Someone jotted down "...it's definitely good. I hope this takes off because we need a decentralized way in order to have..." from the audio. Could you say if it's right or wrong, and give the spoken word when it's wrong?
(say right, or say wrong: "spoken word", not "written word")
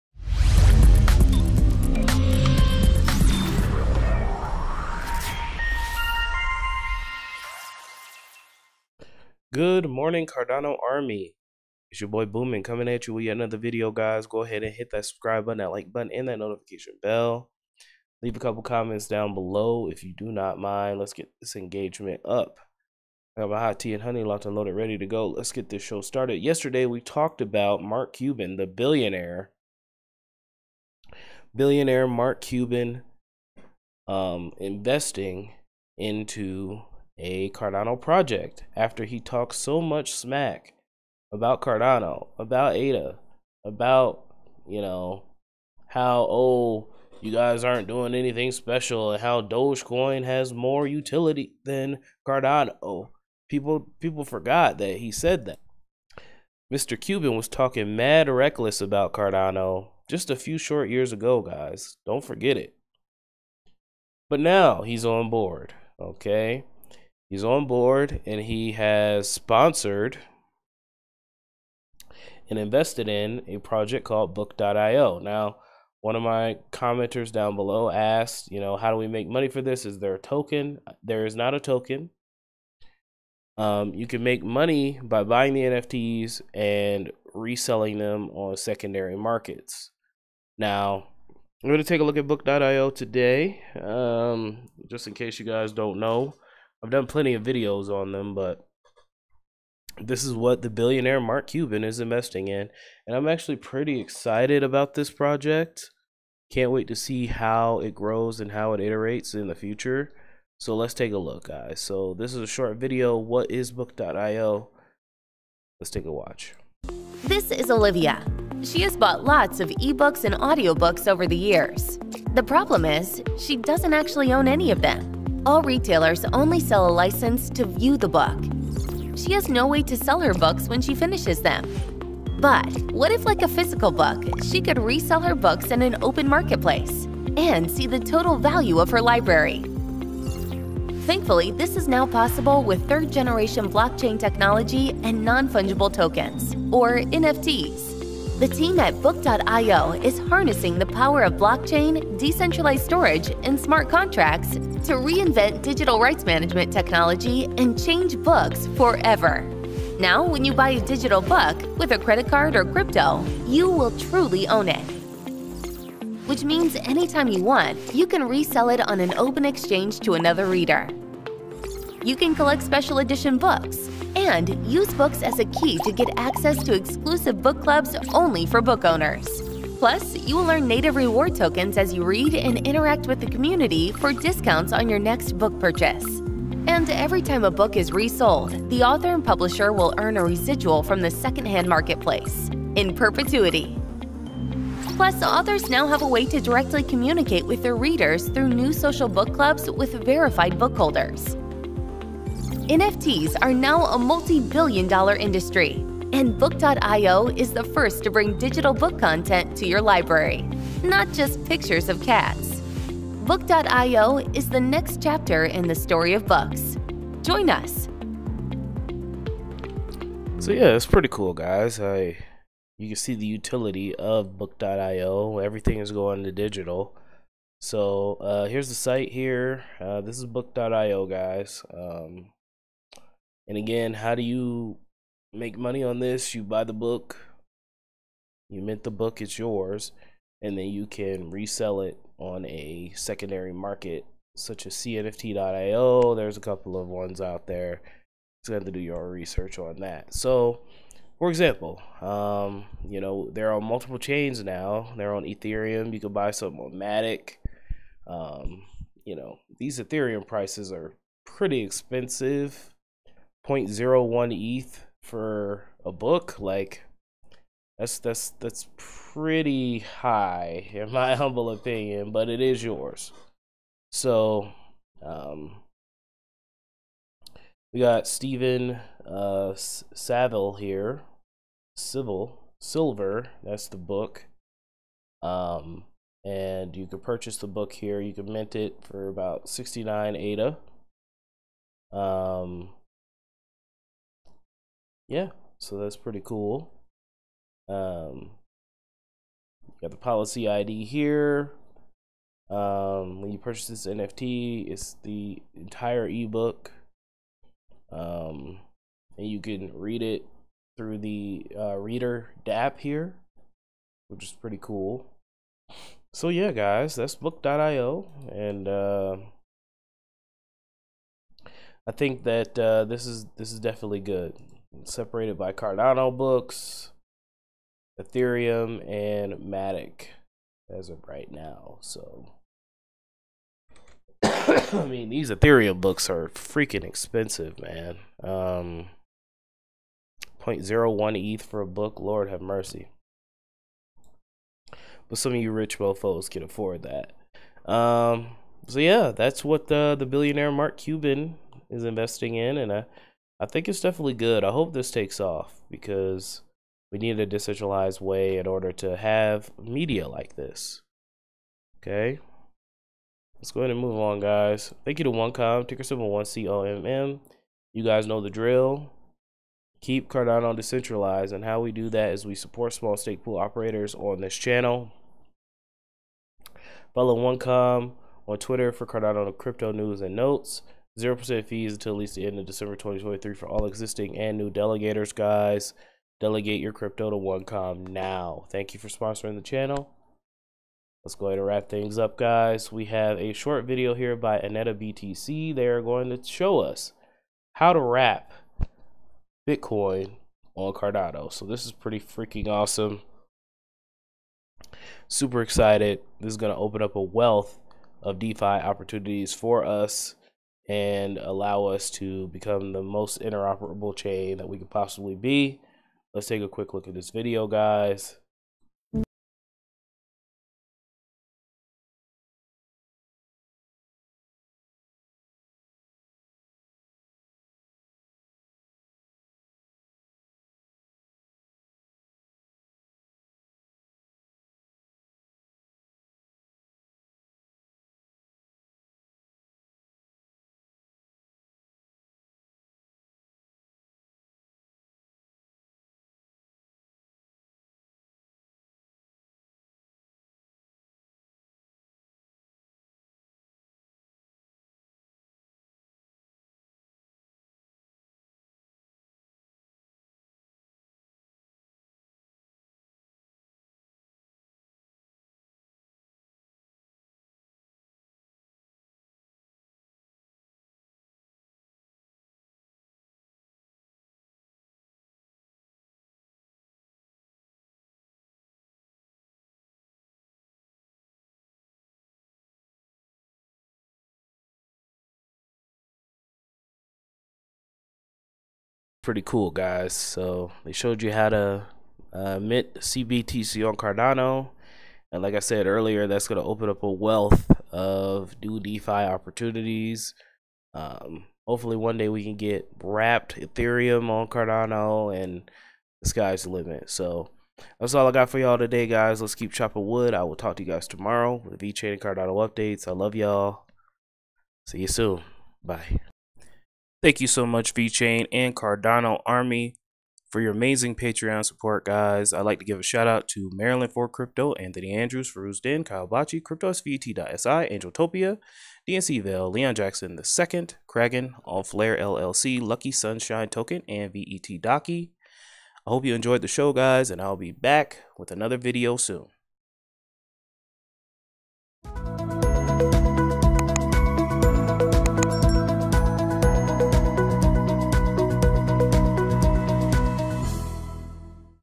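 right.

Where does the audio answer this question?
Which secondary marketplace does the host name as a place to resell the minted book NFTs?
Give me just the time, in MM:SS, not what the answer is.
04:04.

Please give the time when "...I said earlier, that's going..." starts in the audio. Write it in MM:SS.
08:15.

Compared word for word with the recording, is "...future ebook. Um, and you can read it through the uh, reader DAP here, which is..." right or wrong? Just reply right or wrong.
wrong.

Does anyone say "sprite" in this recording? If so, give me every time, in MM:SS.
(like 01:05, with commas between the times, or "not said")
not said.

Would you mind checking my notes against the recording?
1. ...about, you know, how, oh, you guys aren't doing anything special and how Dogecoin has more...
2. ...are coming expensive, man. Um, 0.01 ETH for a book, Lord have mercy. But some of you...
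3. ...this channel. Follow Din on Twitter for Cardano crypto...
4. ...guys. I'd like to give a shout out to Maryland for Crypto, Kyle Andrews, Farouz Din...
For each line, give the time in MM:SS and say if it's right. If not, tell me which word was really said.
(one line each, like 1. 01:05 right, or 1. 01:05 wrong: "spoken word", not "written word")
1. 00:43 right
2. 05:36 wrong: "freaking", not "coming"
3. 06:14 wrong: "OneCom", not "Din"
4. 08:41 wrong: "Anthony", not "Kyle".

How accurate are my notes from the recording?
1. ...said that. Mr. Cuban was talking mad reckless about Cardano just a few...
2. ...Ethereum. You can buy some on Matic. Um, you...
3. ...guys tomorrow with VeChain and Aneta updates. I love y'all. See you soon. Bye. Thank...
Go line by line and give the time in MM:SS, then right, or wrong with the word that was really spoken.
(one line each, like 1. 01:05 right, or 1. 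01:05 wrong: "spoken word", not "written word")
1. 00:55 right
2. 04:15 right
3. 08:30 wrong: "Cardano", not "Aneta".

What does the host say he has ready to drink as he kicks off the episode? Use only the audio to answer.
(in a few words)
Hot tea and honey.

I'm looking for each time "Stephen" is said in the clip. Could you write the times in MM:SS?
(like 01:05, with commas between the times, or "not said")
04:38.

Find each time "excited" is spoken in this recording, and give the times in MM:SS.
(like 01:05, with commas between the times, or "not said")
01:43, 06:45.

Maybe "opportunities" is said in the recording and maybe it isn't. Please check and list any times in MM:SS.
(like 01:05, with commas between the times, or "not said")
06:48, 08:18.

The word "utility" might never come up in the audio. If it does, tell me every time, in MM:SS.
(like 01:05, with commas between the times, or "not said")
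00:50, 03:43.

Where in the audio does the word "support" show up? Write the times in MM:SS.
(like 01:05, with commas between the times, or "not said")
06:12, 08:41.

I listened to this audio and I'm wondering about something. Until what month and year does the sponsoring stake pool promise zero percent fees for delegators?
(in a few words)
December 2023.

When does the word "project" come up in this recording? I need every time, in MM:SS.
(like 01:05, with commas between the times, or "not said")
00:37, 01:13, 01:45.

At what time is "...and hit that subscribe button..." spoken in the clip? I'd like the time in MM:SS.
00:14.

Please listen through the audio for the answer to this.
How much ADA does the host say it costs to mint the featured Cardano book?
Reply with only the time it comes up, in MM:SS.
04:49.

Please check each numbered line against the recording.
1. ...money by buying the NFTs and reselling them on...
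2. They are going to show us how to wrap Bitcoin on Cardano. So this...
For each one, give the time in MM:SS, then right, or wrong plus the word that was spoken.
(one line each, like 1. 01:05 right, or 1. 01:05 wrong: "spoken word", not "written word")
1. 01:24 right
2. 06:35 right.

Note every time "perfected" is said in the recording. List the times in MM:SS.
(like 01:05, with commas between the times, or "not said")
not said.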